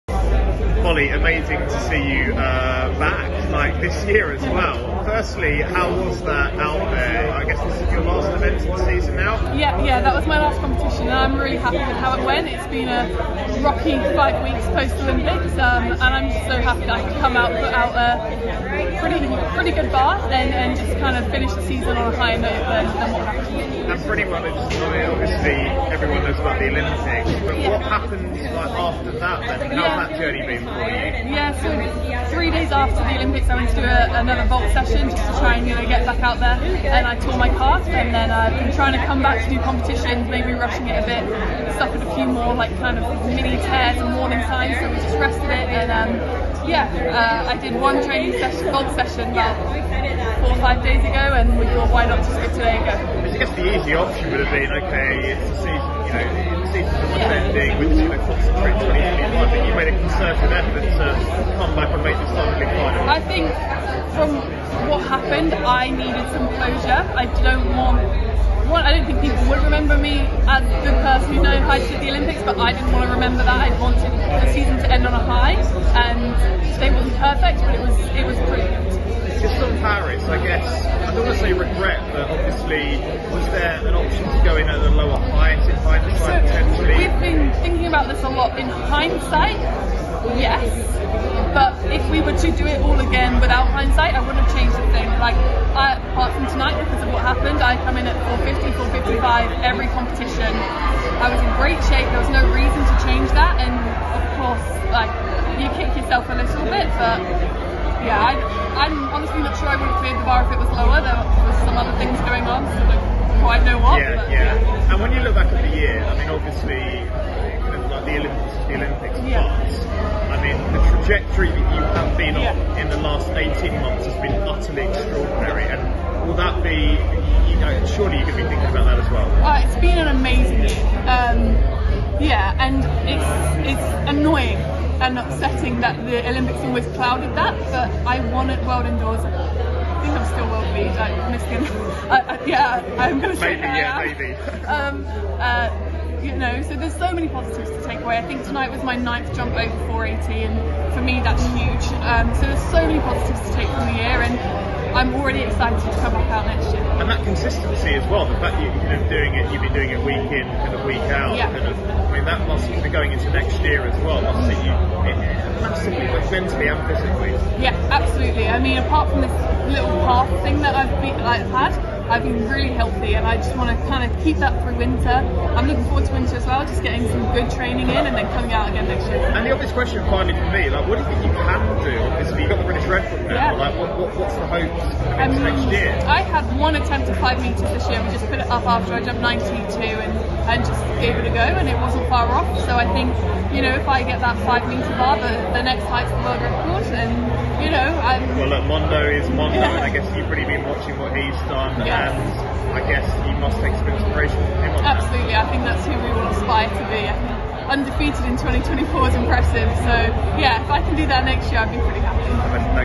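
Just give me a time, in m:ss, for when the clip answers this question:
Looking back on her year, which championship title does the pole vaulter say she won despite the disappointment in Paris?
2:18.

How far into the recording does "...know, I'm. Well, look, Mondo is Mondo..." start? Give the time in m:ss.
3:17.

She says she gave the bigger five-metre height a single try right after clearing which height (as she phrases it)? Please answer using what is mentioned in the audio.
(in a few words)
92.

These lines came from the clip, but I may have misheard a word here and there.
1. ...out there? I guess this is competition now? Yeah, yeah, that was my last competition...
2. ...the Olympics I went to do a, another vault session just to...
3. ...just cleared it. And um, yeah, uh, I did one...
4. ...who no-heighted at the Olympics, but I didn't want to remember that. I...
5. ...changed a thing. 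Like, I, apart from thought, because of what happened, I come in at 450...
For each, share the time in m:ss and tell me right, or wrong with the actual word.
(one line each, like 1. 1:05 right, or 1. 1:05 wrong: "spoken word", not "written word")
1. 0:06 wrong: "season", not "competition"
2. 0:33 right
3. 0:44 wrong: "rested", not "cleared"
4. 1:11 right
5. 1:34 wrong: "tonight", not "thought".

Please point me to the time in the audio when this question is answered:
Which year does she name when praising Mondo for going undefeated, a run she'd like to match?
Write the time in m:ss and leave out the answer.
3:28.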